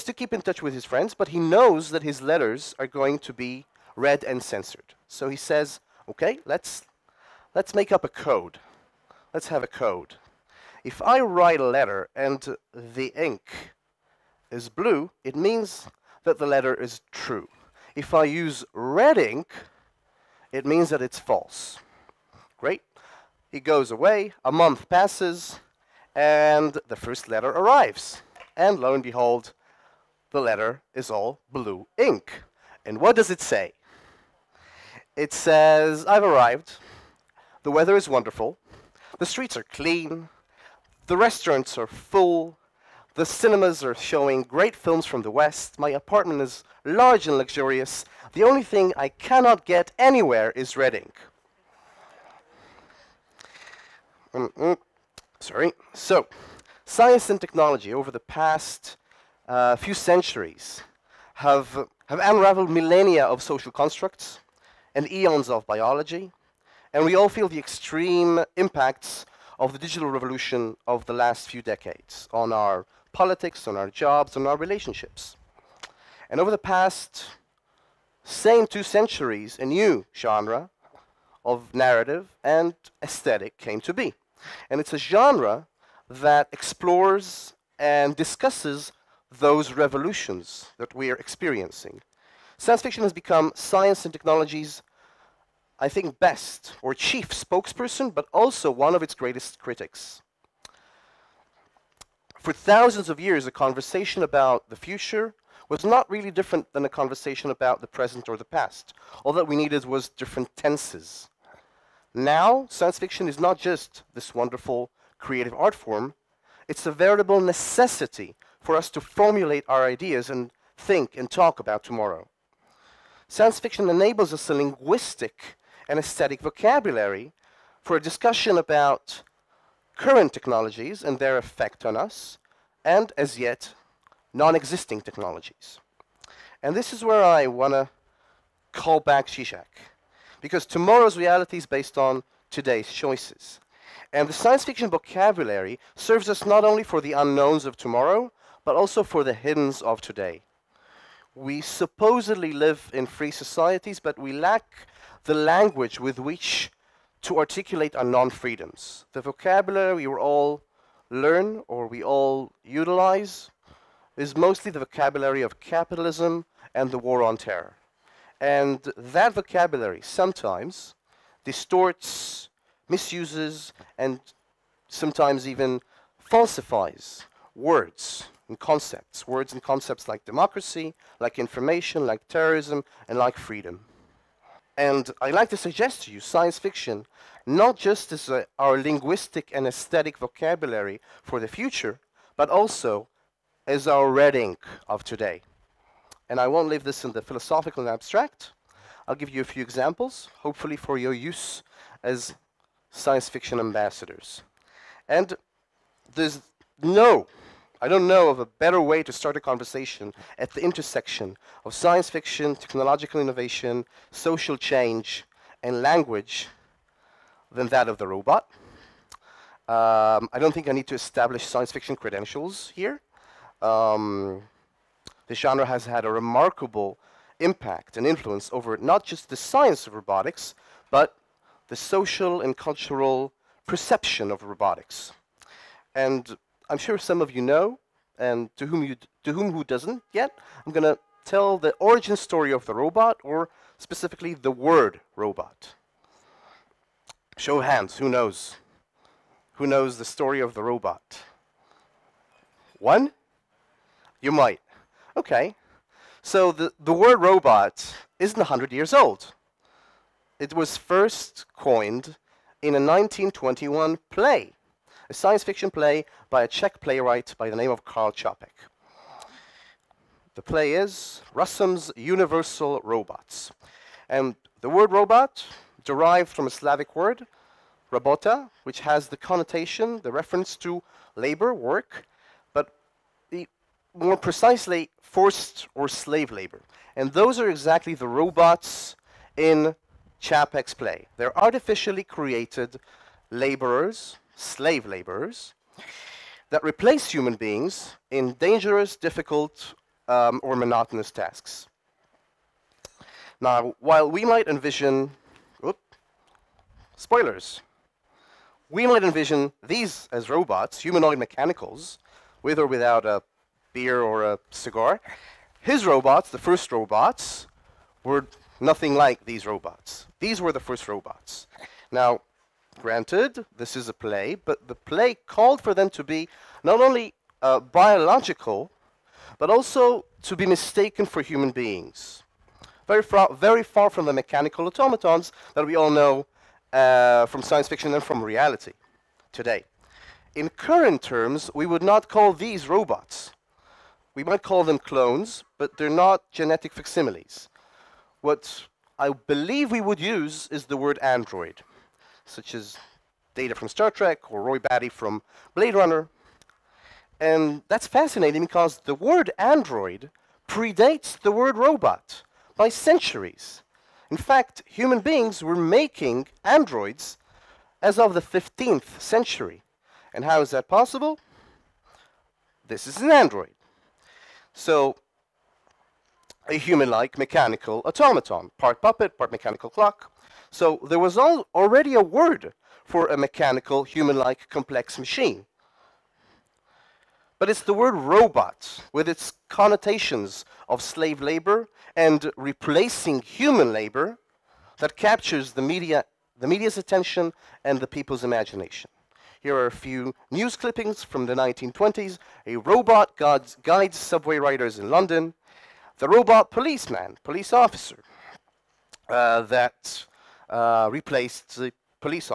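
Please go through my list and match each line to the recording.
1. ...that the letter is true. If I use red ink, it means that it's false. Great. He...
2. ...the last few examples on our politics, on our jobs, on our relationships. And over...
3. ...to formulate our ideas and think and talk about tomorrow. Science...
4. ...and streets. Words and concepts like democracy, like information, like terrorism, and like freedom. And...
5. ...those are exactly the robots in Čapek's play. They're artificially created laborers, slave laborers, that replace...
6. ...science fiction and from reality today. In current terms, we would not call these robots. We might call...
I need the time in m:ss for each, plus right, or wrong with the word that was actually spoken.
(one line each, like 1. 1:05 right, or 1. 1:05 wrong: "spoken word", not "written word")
1. 0:16 right
2. 1:11 wrong: "decades", not "examples"
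3. 1:58 right
4. 2:58 wrong: "concepts", not "streets"
5. 4:47 right
6. 5:37 right.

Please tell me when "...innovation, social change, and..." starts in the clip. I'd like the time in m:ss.
3:33.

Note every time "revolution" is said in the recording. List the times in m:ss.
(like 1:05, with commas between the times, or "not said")
1:10, 1:29.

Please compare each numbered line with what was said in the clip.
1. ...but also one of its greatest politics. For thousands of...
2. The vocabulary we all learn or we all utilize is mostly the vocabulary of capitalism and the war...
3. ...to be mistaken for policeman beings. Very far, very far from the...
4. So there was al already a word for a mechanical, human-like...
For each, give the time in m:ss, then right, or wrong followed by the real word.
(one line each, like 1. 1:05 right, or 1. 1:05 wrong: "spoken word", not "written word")
1. 1:38 wrong: "critics", not "politics"
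2. 2:39 right
3. 5:30 wrong: "human", not "policeman"
4. 6:20 right.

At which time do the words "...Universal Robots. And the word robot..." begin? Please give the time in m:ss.
4:31.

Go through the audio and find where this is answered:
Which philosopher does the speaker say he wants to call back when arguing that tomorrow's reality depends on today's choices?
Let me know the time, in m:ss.
2:19.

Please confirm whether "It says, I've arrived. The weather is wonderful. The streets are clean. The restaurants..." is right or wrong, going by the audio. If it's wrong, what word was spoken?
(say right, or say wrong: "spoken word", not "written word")
right.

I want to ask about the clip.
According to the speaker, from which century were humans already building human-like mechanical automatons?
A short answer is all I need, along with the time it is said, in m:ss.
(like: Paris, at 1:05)
15th century, at 6:08.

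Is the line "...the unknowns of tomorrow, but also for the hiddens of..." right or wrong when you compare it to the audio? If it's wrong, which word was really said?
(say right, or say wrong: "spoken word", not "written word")
right.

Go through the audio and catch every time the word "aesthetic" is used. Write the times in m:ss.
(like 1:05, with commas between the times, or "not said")
1:23, 2:05, 3:09.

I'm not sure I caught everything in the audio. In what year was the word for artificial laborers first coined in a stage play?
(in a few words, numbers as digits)
1921.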